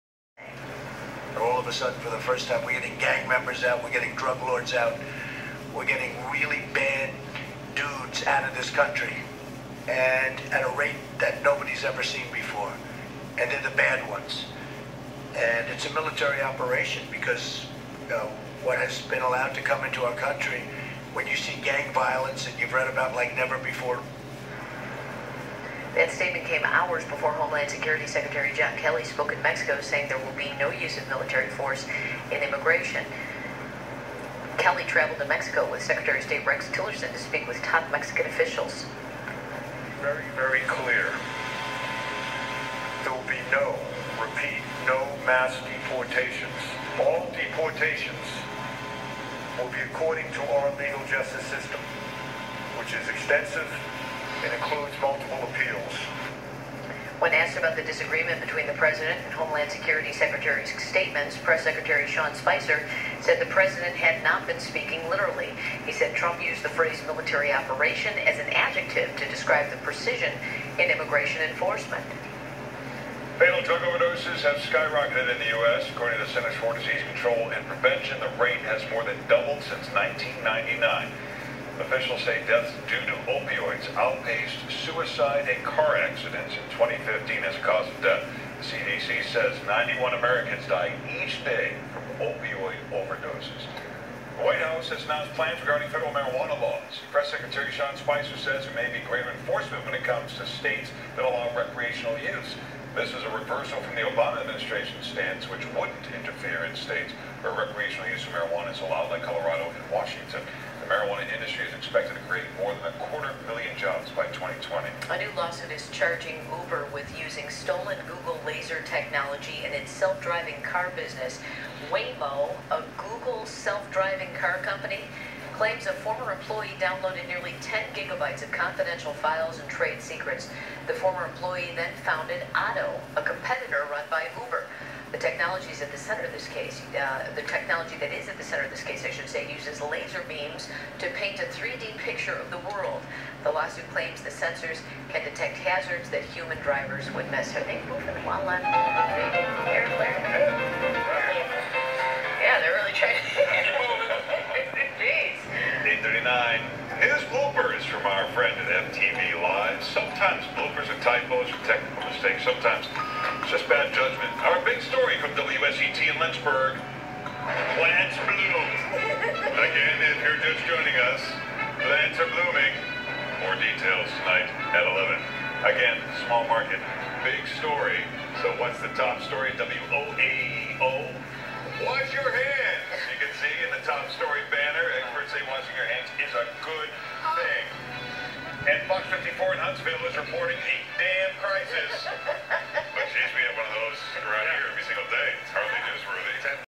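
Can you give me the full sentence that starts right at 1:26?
2015 as a cause of death.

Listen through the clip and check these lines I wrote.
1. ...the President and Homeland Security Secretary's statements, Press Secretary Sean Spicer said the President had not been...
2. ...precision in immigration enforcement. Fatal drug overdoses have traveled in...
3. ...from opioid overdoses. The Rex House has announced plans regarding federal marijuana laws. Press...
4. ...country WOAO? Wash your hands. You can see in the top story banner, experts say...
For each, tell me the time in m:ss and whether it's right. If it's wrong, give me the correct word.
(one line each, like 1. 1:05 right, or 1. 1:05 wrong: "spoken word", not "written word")
1. 0:58 right
2. 1:09 wrong: "skyrocketed", not "traveled"
3. 1:31 wrong: "White", not "Rex"
4. 2:59 wrong: "story", not "country".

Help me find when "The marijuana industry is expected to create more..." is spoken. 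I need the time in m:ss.
1:50.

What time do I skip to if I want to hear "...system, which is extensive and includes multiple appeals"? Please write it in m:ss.
0:51.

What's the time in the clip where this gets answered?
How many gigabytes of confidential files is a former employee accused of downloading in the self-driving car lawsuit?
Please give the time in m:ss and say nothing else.
2:07.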